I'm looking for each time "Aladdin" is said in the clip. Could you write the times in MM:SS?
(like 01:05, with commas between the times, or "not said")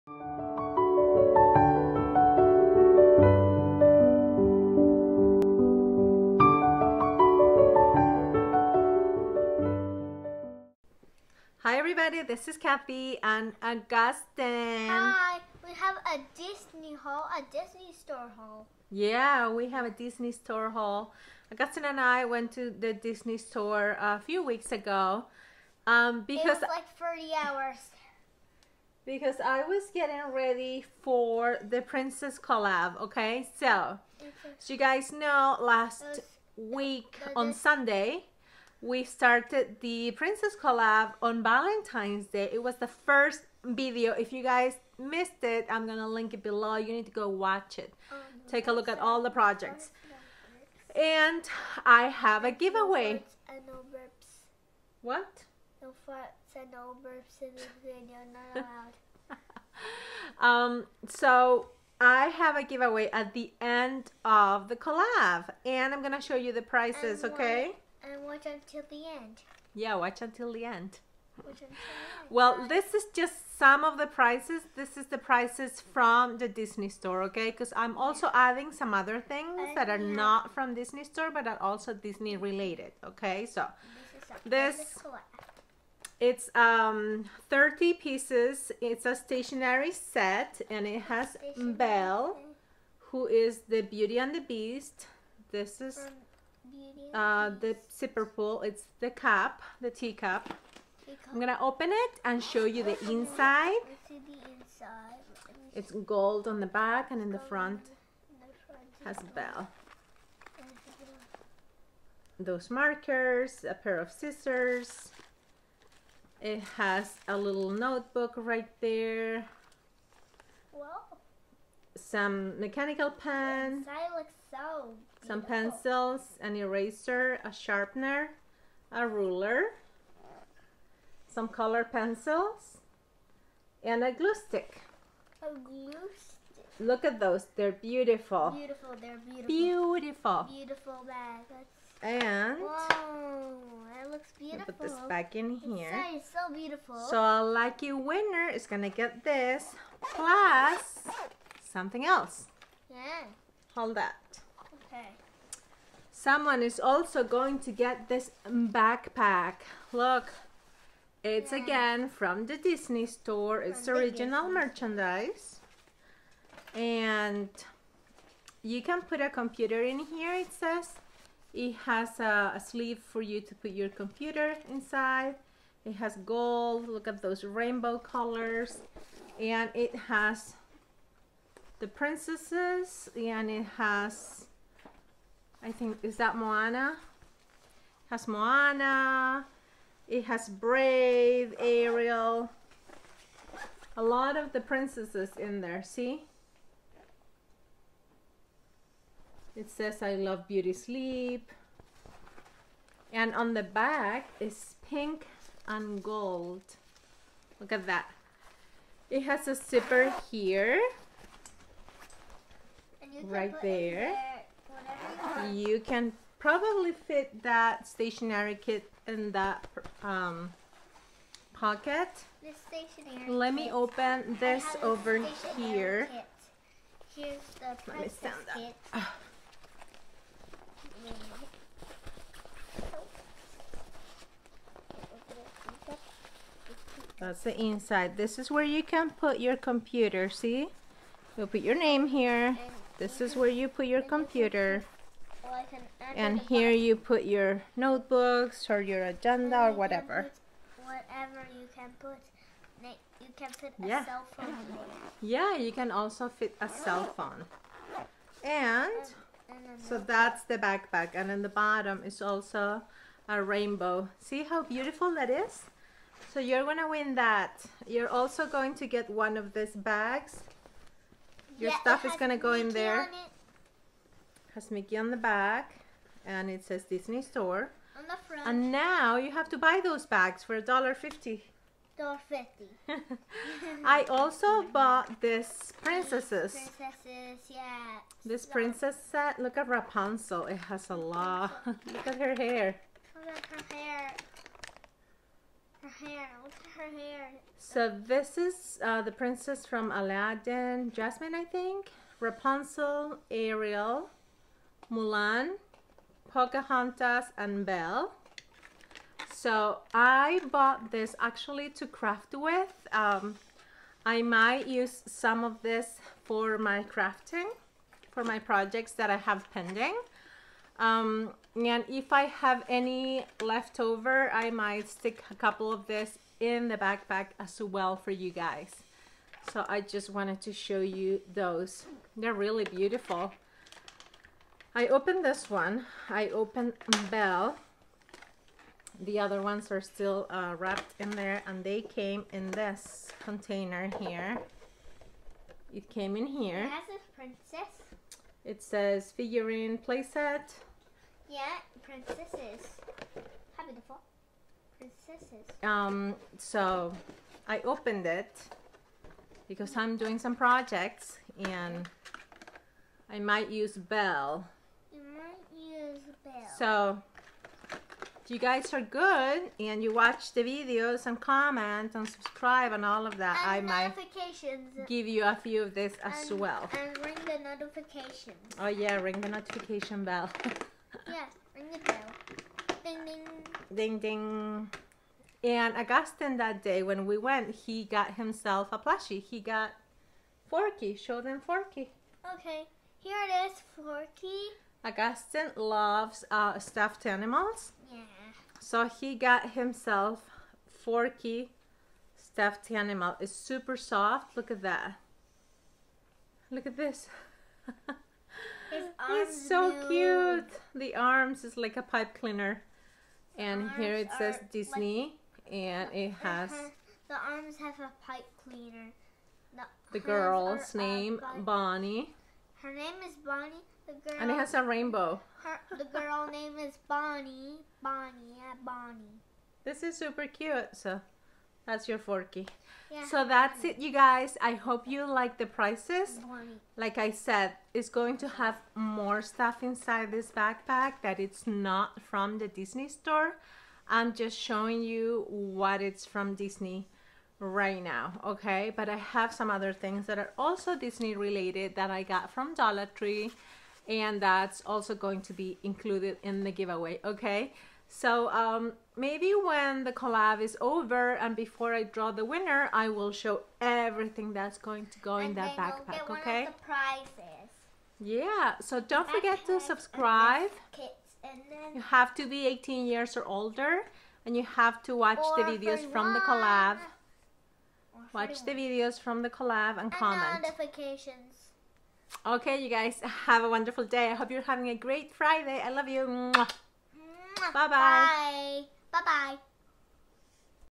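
04:59.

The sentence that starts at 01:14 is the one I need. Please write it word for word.
This is the prices from the Disney store, okay?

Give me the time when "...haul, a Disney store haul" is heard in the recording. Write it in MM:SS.
00:16.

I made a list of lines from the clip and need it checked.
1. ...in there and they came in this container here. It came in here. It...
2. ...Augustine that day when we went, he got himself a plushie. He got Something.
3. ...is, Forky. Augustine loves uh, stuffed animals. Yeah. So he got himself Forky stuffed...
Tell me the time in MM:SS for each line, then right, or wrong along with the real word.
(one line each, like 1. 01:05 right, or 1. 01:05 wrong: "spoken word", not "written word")
1. 05:40 right
2. 06:25 wrong: "Forky", not "Something"
3. 06:33 right.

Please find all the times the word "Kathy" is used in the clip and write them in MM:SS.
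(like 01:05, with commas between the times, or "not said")
00:12.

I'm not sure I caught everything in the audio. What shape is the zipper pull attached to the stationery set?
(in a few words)
teacup.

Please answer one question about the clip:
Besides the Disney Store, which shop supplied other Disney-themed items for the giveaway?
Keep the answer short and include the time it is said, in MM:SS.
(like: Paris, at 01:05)
Dollar Tree, at 07:32.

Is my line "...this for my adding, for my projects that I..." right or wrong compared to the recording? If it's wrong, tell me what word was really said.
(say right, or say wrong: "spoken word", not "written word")
wrong: "crafting", not "adding".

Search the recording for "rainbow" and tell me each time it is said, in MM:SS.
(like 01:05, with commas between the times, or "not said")
02:57, 04:23, 07:04.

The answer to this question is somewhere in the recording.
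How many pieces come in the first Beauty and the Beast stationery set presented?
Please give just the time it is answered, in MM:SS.
01:26.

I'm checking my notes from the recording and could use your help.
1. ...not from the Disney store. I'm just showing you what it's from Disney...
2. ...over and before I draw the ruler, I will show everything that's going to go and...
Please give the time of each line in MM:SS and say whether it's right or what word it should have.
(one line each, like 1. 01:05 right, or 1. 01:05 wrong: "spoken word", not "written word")
1. 07:21 right
2. 07:40 wrong: "winner", not "ruler".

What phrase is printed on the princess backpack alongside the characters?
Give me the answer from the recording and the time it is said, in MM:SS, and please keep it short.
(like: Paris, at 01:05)
I love beauty sleep, at 03:20.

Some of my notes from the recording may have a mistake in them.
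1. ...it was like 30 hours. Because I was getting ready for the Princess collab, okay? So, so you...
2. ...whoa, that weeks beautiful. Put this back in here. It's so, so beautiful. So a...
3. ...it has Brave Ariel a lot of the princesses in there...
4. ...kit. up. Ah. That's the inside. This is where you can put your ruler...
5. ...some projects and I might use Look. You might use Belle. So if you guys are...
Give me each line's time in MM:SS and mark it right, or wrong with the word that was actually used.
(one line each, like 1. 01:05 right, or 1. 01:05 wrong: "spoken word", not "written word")
1. 00:26 right
2. 02:22 wrong: "looks", not "weeks"
3. 03:10 right
4. 03:48 wrong: "computer", not "ruler"
5. 06:00 wrong: "Belle", not "Look".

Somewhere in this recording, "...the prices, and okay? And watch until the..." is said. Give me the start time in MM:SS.
01:06.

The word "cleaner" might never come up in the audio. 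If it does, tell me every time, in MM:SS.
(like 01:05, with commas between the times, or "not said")
06:52, 06:58.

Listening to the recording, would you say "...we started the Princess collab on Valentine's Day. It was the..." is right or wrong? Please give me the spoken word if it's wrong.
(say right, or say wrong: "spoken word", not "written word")
right.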